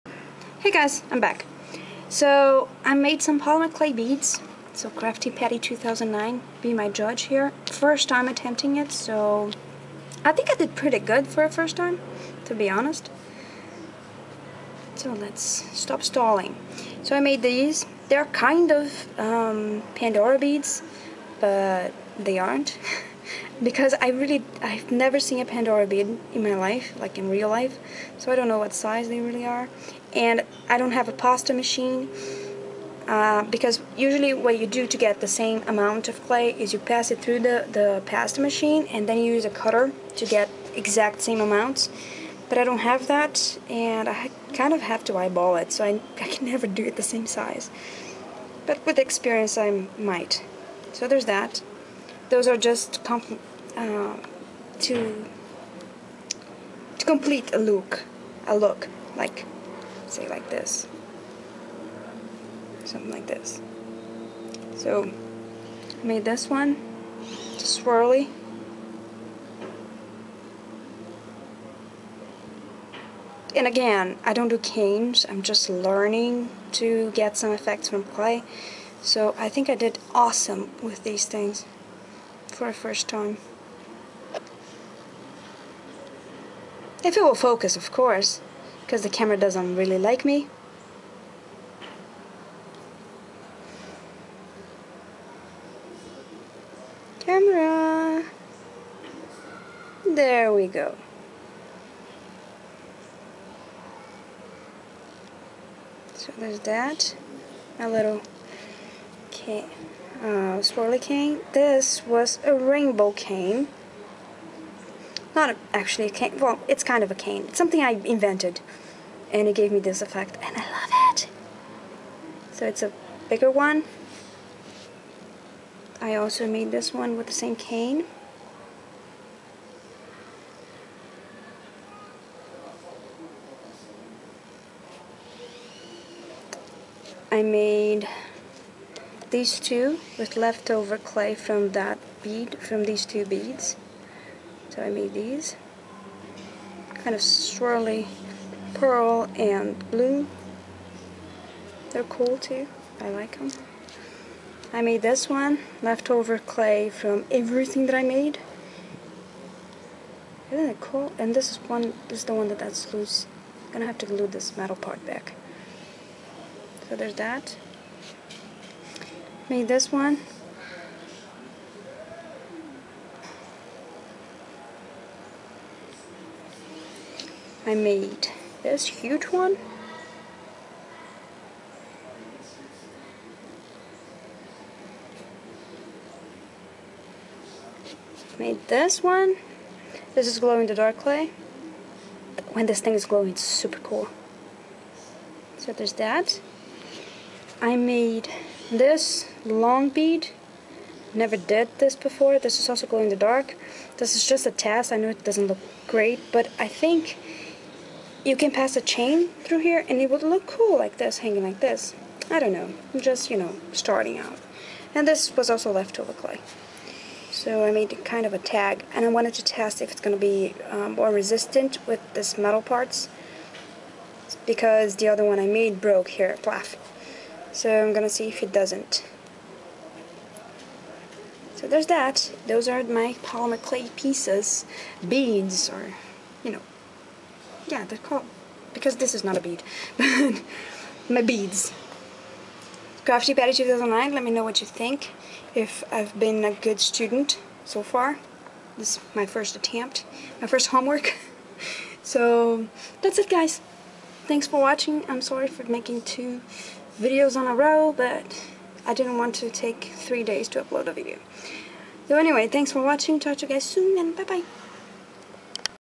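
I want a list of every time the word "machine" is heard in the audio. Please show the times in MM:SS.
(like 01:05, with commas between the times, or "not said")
00:31, 00:38.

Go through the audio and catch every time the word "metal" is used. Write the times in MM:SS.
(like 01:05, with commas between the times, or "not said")
02:44, 03:42.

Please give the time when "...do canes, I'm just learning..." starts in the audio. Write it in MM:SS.
01:14.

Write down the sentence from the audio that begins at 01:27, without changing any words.
If it will focus, of course, because the camera doesn't really like me.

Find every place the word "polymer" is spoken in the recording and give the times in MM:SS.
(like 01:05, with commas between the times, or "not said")
00:03, 03:53.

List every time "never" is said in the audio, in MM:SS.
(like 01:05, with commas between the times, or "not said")
00:24, 00:46, 03:21.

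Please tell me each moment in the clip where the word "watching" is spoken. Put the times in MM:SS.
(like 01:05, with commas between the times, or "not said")
04:14, 04:22.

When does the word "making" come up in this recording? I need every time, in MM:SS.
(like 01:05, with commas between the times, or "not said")
04:15.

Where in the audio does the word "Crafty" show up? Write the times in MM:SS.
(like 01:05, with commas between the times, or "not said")
00:04, 04:03.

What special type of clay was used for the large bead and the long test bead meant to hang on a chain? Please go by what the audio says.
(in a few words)
glow in the dark clay.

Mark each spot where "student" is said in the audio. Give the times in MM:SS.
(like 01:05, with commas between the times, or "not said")
04:06.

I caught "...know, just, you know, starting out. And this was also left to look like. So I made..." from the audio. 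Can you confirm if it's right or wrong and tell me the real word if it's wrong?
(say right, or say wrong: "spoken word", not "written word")
right.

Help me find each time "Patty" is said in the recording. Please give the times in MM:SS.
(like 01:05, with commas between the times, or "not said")
00:05, 04:03.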